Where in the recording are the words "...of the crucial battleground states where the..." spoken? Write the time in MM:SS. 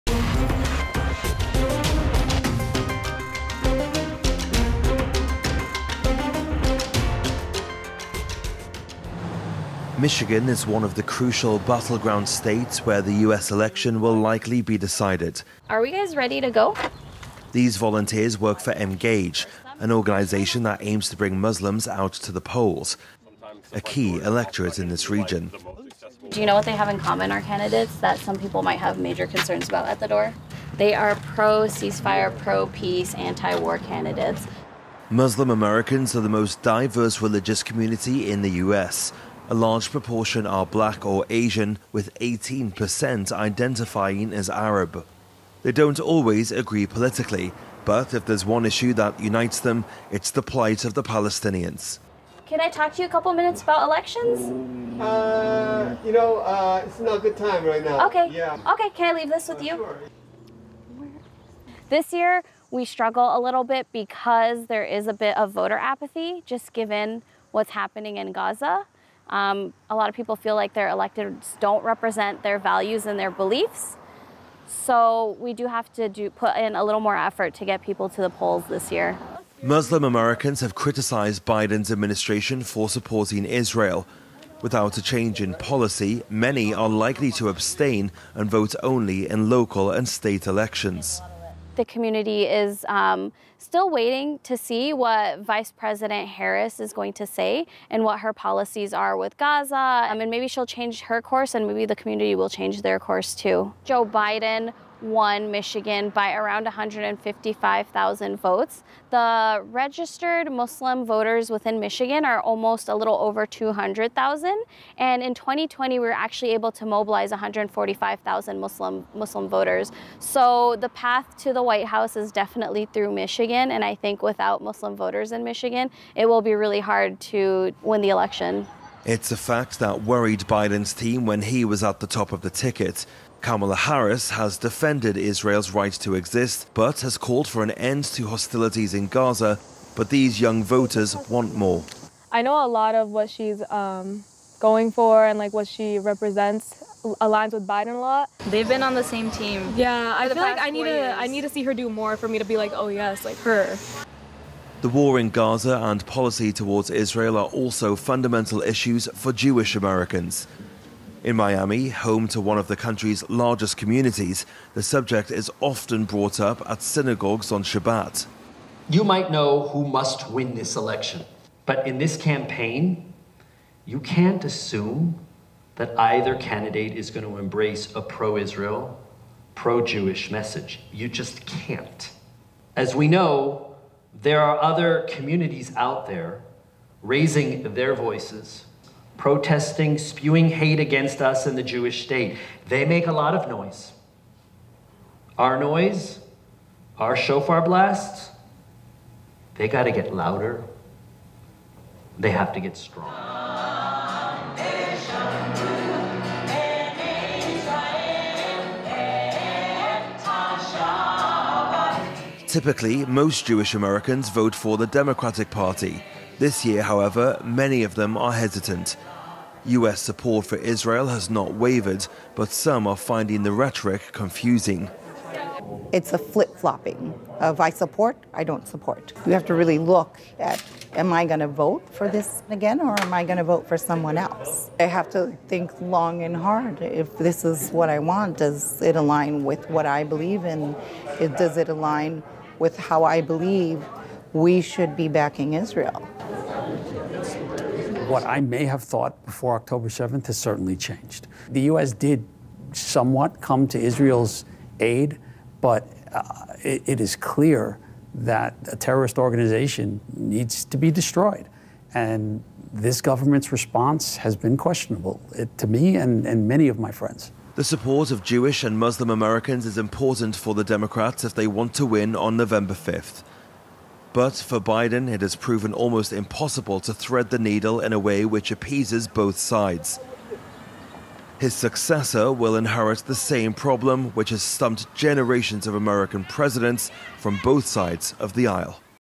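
00:10.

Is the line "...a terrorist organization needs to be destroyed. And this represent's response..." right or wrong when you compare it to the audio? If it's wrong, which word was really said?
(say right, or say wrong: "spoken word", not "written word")
wrong: "government", not "represent".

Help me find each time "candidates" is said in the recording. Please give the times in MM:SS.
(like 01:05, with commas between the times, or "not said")
00:27, 00:33, 02:56.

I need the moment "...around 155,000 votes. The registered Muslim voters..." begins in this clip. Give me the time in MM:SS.
01:46.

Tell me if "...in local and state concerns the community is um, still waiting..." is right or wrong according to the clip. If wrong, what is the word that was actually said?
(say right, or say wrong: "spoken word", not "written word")
wrong: "elections", not "concerns".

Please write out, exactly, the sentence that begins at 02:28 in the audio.
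They've been on the same team.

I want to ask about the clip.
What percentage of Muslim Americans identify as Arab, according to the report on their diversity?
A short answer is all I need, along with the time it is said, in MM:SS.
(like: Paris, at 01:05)
18%, at 00:42.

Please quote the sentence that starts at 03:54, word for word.
I have to think long and hard if this is what I want.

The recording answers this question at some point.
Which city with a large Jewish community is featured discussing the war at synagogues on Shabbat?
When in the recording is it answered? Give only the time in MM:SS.
02:41.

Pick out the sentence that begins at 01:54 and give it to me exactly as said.
And in 2020, we were actually able to mobilize 145,000 Muslim, Muslim voters.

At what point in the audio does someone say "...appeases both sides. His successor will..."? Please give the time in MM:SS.
04:38.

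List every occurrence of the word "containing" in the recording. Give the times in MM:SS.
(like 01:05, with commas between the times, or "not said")
not said.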